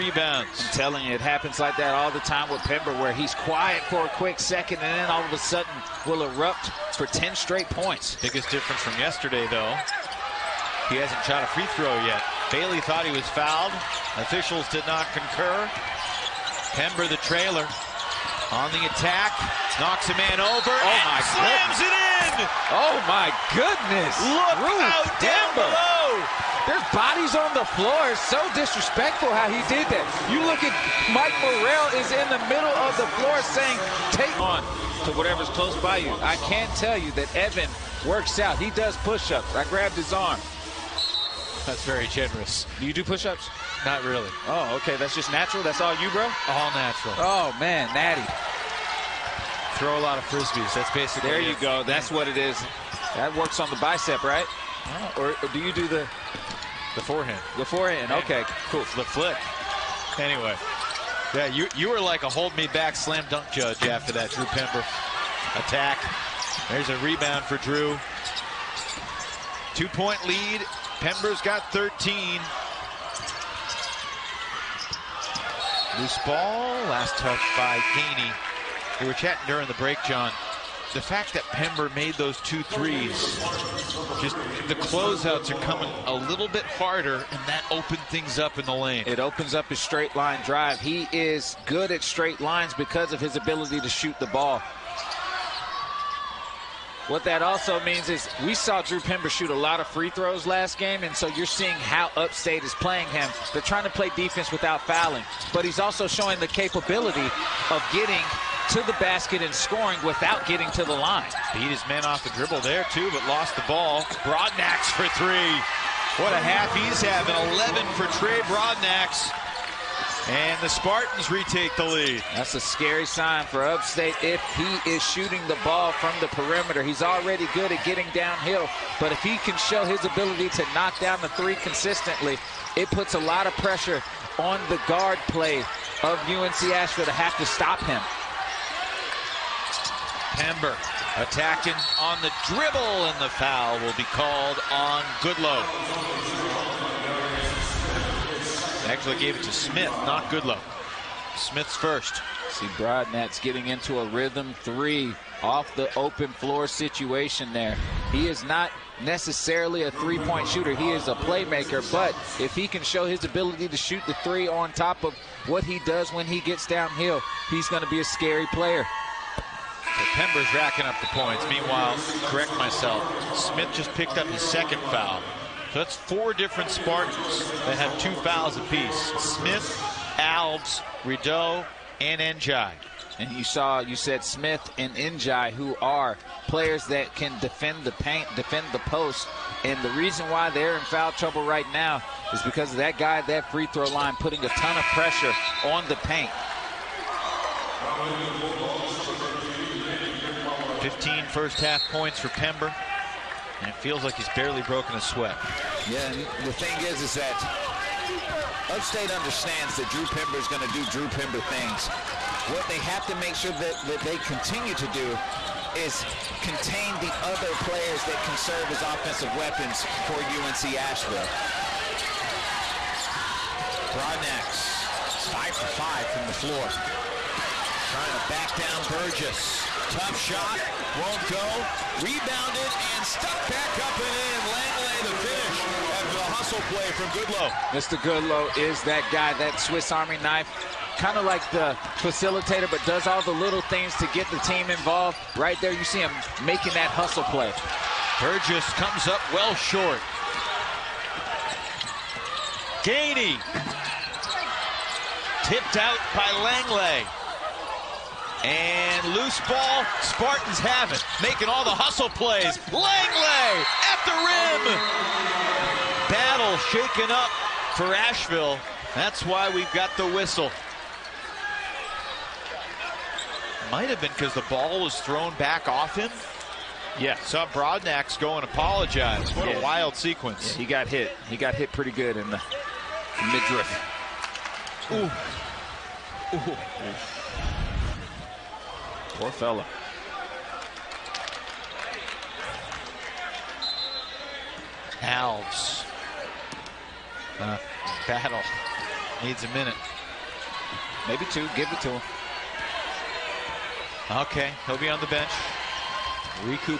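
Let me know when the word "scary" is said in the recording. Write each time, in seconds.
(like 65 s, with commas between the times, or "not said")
122 s, 168 s.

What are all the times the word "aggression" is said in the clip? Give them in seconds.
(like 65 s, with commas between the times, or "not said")
not said.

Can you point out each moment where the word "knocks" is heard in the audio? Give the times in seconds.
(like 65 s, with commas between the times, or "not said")
19 s, 130 s.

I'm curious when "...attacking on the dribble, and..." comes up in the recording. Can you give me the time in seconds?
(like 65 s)
141 s.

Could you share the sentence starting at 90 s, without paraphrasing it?
He is good at straight lines because of his ability to shoot the ball.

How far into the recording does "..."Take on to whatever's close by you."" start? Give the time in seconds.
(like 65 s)
34 s.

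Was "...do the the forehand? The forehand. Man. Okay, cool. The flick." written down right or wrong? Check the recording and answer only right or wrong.
right.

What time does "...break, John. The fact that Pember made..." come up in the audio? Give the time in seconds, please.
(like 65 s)
79 s.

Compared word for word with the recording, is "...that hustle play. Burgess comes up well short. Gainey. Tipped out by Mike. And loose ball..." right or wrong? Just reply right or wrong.
wrong.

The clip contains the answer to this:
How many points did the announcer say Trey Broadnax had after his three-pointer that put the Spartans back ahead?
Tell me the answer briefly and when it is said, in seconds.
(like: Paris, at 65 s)
11, at 117 s.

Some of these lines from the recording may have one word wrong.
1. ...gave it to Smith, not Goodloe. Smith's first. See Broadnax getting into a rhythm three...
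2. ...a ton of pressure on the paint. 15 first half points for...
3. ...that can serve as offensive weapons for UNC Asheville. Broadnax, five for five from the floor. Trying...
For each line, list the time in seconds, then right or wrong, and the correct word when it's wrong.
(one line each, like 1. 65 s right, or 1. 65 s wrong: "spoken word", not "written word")
1. 149 s right
2. 194 s right
3. 218 s right.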